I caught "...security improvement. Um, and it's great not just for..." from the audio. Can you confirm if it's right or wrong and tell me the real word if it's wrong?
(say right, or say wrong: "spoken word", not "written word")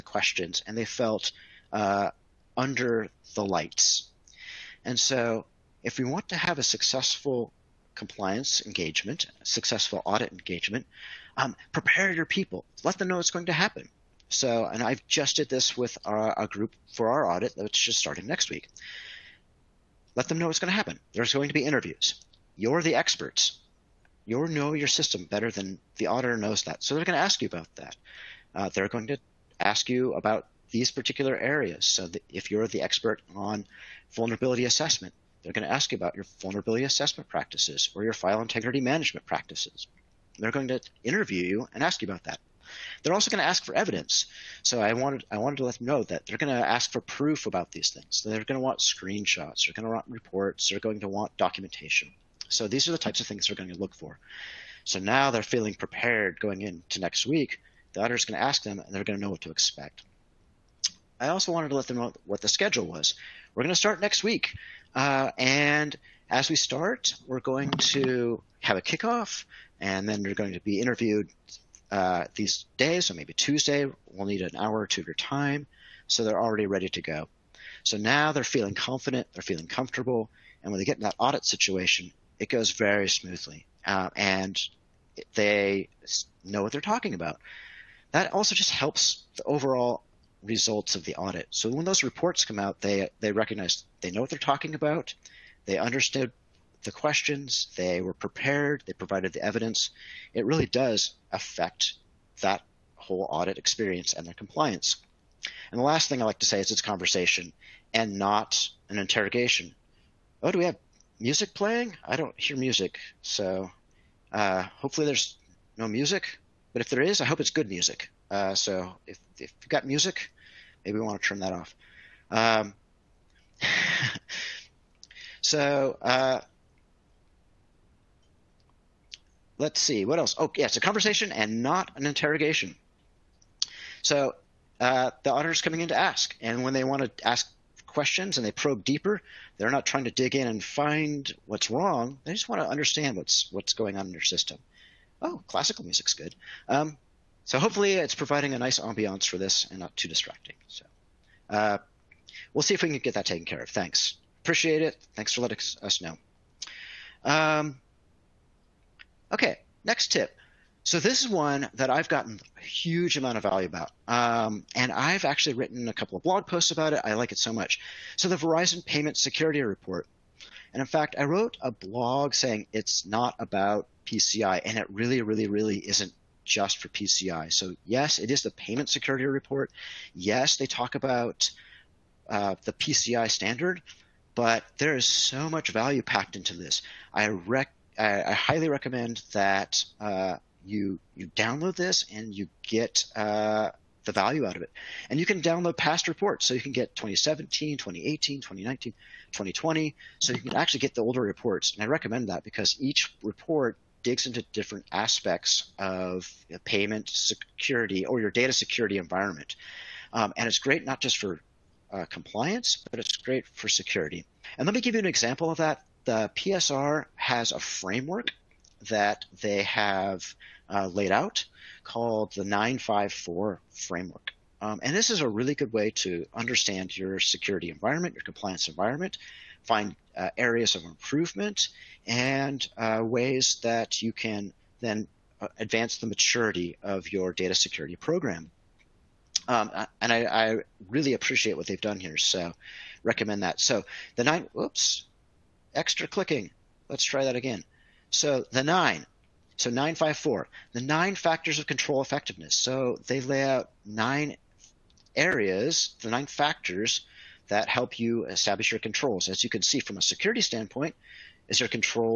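wrong: "environment", not "improvement".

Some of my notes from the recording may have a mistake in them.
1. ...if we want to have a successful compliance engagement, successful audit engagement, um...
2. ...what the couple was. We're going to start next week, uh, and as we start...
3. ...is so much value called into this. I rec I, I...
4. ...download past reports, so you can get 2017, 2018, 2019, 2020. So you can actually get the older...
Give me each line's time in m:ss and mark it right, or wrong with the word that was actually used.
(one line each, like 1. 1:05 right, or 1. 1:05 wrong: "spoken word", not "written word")
1. 0:05 right
2. 1:02 wrong: "schedule", not "couple"
3. 3:04 wrong: "packed", not "called"
4. 3:15 right.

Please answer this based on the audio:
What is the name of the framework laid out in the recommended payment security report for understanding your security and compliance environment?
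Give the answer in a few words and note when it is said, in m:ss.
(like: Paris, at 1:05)
954 framework, at 3:42.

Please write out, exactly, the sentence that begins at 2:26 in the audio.
Um, so hopefully it's providing a nice ambiance for this and not too distracting.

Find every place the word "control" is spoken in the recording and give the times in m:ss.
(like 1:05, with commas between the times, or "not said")
4:11, 4:18.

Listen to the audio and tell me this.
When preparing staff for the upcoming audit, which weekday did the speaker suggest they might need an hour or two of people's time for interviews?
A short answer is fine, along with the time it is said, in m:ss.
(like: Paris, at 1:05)
Tuesday, at 1:13.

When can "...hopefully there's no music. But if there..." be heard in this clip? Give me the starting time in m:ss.
1:54.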